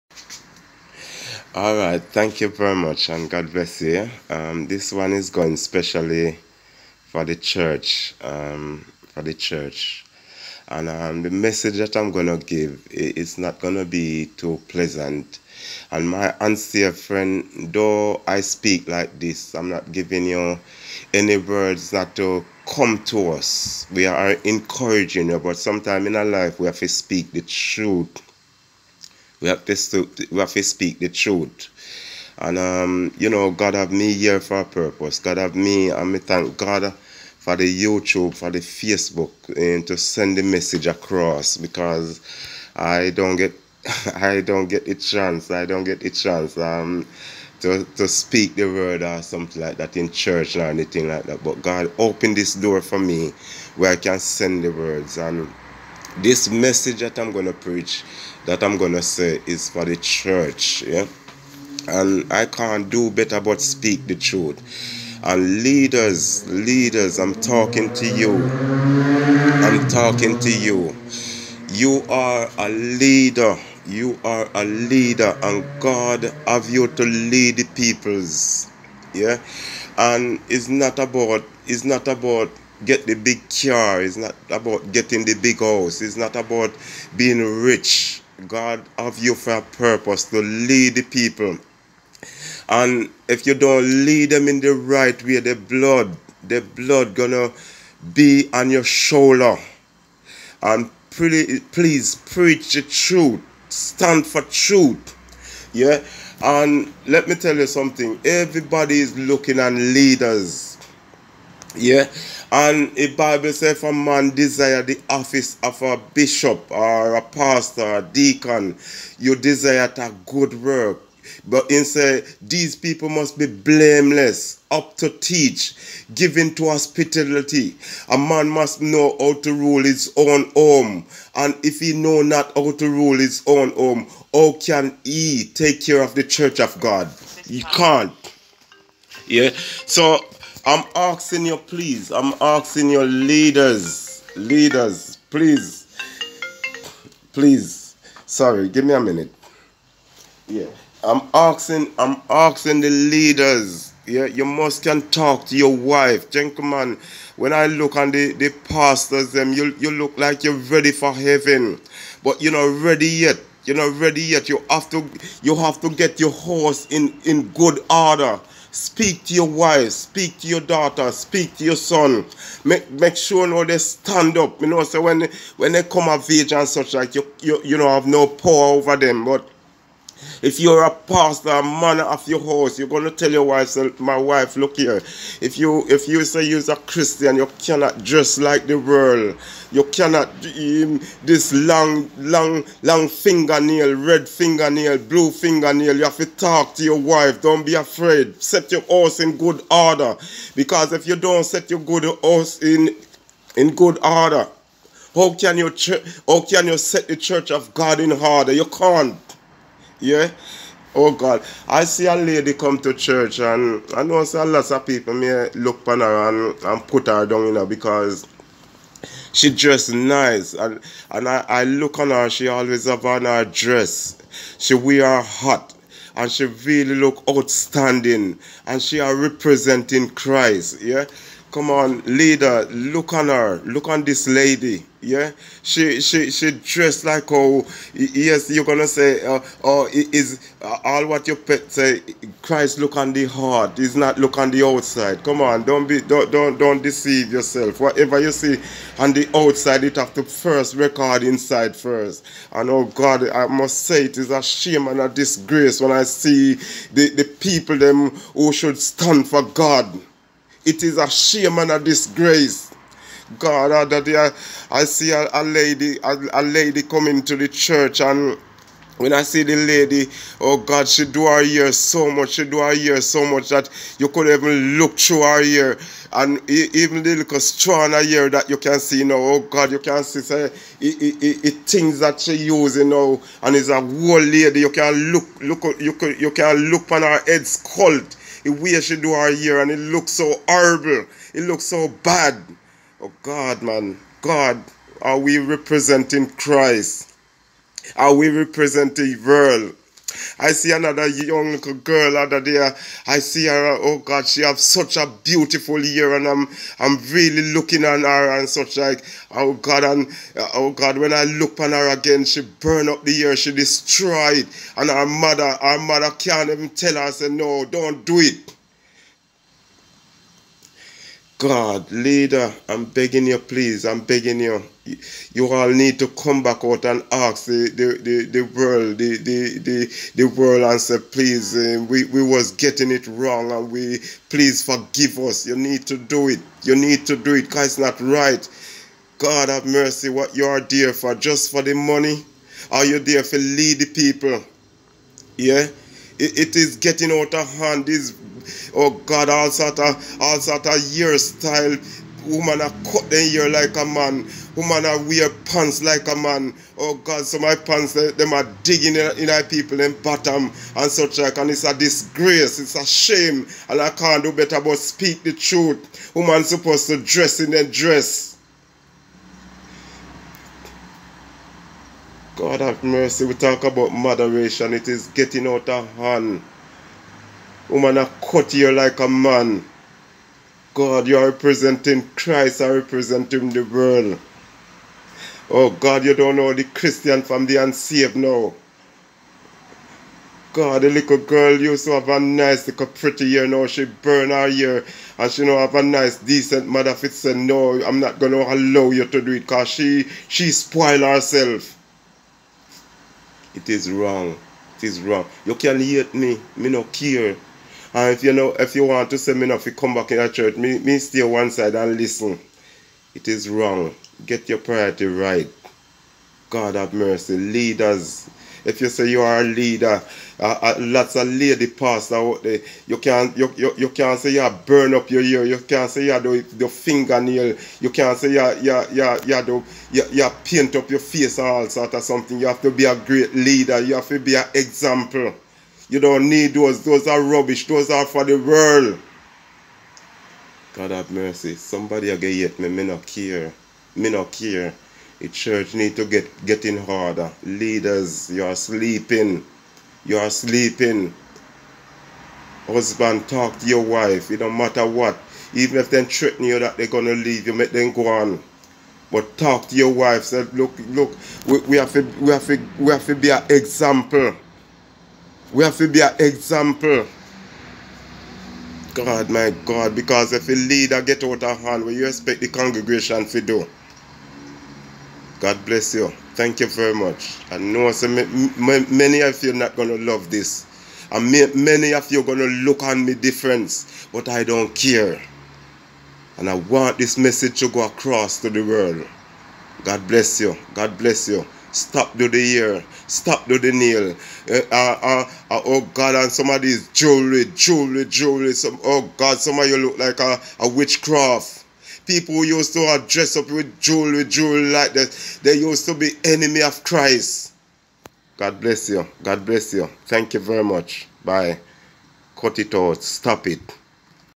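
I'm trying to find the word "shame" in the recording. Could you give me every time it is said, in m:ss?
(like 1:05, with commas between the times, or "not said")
4:14, 4:21, 6:02.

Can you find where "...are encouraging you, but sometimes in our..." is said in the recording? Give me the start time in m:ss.
0:24.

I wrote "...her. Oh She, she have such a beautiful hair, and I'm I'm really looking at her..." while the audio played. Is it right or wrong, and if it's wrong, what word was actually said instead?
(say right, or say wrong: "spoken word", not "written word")
wrong: "God", not "She".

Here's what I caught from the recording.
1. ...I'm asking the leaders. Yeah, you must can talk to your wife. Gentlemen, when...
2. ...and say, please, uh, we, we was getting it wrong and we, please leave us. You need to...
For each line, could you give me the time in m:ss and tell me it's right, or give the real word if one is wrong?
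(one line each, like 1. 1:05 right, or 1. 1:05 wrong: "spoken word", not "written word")
1. 2:31 right
2. 5:30 wrong: "forgive", not "leave".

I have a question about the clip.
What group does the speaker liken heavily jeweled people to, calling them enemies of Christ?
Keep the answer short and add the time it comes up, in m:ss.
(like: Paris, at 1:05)
witchcraft people, at 8:20.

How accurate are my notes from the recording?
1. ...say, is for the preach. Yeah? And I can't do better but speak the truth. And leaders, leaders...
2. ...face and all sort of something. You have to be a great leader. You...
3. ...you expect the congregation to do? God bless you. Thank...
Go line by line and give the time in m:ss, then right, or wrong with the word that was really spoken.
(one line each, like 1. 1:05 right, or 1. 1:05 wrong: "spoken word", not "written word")
1. 0:59 wrong: "church", not "preach"
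2. 7:10 right
3. 7:51 right.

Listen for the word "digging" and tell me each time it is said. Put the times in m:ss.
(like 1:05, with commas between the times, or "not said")
5:58.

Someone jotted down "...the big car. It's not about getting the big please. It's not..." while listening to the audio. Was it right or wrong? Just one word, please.
wrong.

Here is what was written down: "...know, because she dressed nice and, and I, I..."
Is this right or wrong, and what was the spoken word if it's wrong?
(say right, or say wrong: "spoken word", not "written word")
right.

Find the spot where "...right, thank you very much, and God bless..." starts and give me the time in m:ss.
0:01.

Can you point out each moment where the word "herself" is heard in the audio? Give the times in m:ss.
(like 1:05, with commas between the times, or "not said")
6:41.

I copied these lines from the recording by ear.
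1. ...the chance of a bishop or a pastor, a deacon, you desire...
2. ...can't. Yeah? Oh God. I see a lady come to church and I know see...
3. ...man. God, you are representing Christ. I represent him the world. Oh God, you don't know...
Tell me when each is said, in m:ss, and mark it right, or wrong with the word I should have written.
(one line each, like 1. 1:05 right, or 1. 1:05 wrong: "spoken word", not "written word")
1. 1:54 wrong: "office", not "chance"
2. 3:28 right
3. 6:19 right.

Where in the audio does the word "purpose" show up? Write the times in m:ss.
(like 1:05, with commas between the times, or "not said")
0:34, 1:29.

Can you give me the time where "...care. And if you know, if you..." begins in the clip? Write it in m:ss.
6:46.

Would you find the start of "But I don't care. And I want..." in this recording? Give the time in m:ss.
8:04.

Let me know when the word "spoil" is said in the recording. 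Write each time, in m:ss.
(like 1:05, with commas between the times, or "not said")
6:40.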